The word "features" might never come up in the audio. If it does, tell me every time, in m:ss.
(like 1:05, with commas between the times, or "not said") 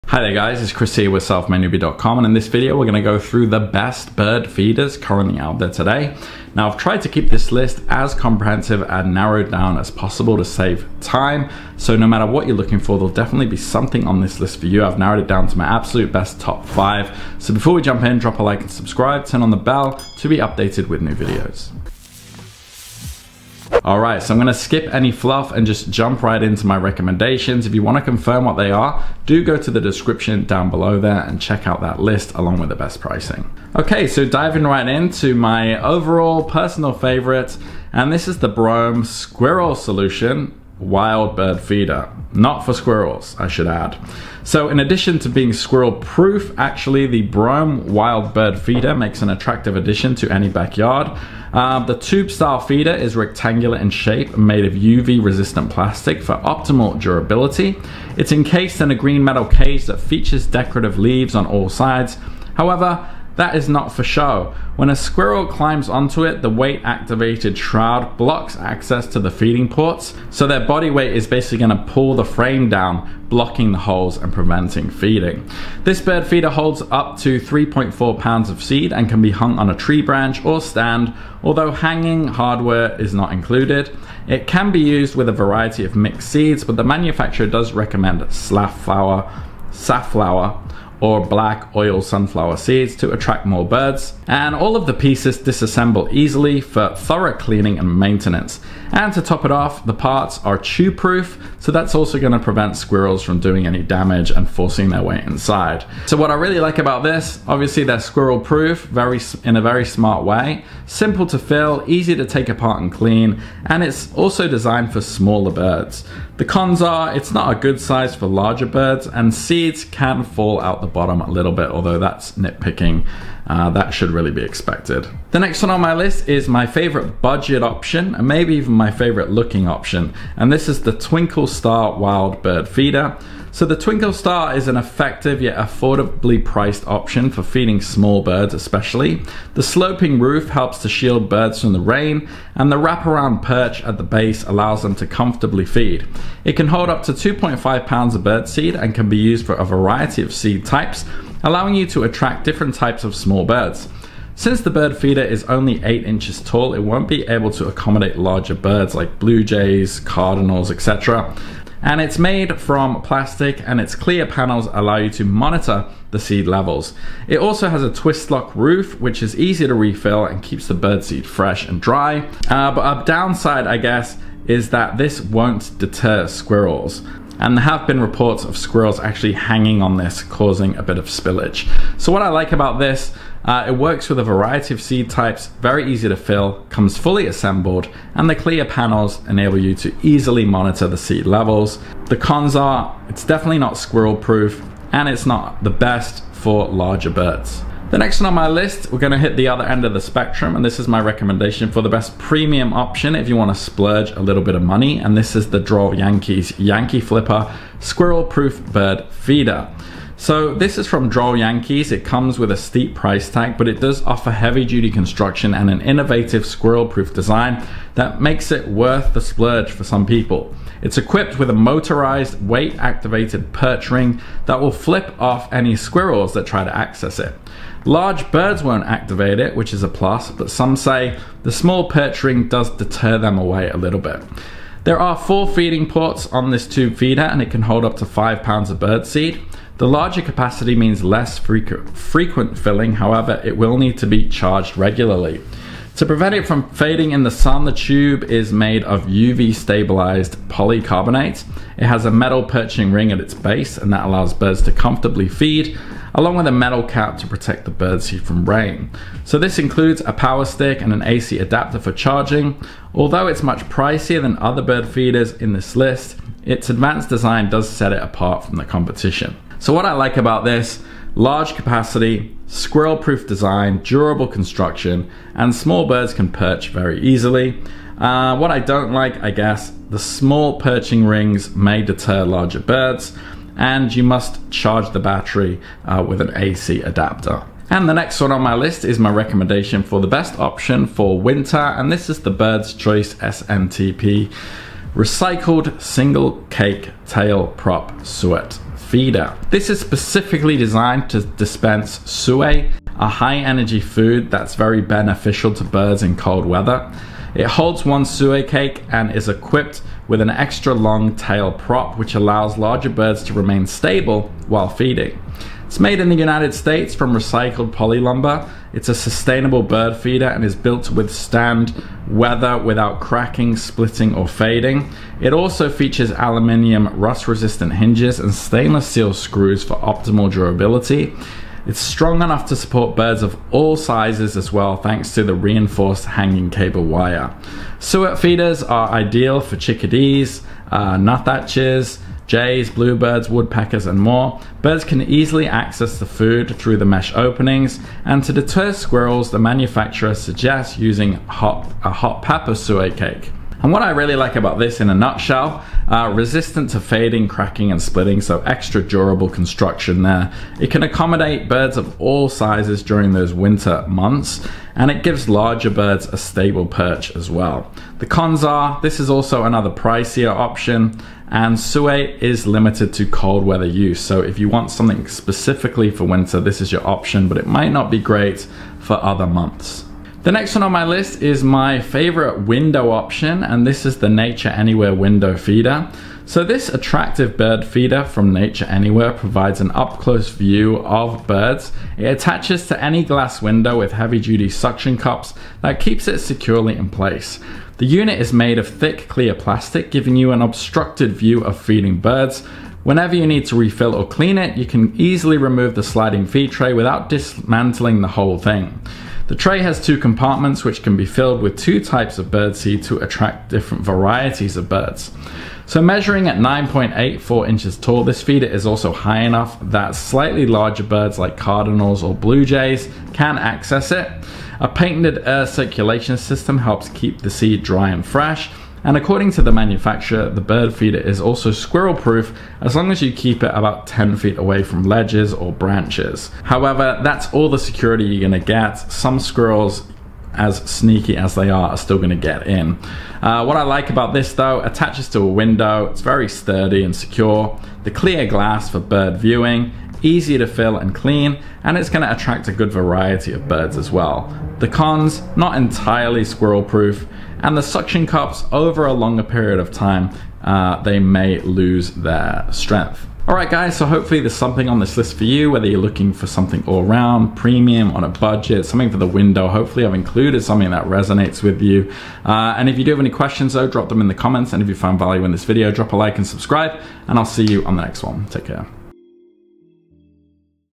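0:59, 5:25.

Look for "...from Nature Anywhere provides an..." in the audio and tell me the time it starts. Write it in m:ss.
6:28.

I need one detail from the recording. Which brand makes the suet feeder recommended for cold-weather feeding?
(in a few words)
Bird's Choice.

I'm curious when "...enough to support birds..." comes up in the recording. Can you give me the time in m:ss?
5:32.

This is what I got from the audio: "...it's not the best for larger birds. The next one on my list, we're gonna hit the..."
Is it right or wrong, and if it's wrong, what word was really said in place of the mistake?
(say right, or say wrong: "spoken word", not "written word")
right.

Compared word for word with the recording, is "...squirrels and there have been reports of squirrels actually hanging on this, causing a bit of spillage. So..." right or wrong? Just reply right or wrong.
right.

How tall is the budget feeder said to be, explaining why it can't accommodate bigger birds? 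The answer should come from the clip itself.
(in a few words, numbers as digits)
8 inches.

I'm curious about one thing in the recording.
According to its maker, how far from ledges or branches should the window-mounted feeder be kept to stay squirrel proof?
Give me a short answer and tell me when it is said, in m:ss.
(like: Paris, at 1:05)
10 feet, at 7:13.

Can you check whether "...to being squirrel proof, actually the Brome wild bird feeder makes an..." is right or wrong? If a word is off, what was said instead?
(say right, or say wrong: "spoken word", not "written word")
right.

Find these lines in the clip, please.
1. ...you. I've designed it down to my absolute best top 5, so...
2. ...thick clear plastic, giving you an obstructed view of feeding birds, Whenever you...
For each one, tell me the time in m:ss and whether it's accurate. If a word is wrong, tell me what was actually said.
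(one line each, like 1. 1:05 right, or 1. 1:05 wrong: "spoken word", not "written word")
1. 0:14 wrong: "narrowed", not "designed"
2. 6:38 right.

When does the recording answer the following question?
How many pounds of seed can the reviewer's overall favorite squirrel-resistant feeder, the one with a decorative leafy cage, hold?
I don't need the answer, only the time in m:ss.
1:17.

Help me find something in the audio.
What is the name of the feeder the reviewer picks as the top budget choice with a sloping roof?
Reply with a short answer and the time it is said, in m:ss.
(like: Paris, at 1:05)
Twinkle Star Wild Bird Feeder, at 2:10.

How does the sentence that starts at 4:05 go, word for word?
To prevent it from fading in the sun, the tube is made of UV stabilized polycarbonate.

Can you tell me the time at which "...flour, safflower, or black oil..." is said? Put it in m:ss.
1:28.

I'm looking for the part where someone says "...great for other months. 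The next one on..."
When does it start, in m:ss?
6:17.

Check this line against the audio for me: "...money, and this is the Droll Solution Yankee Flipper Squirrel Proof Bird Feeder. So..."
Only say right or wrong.
wrong.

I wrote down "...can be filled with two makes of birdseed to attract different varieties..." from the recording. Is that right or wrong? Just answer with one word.
wrong.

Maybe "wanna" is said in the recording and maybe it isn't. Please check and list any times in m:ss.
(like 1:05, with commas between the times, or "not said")
0:27, 3:23.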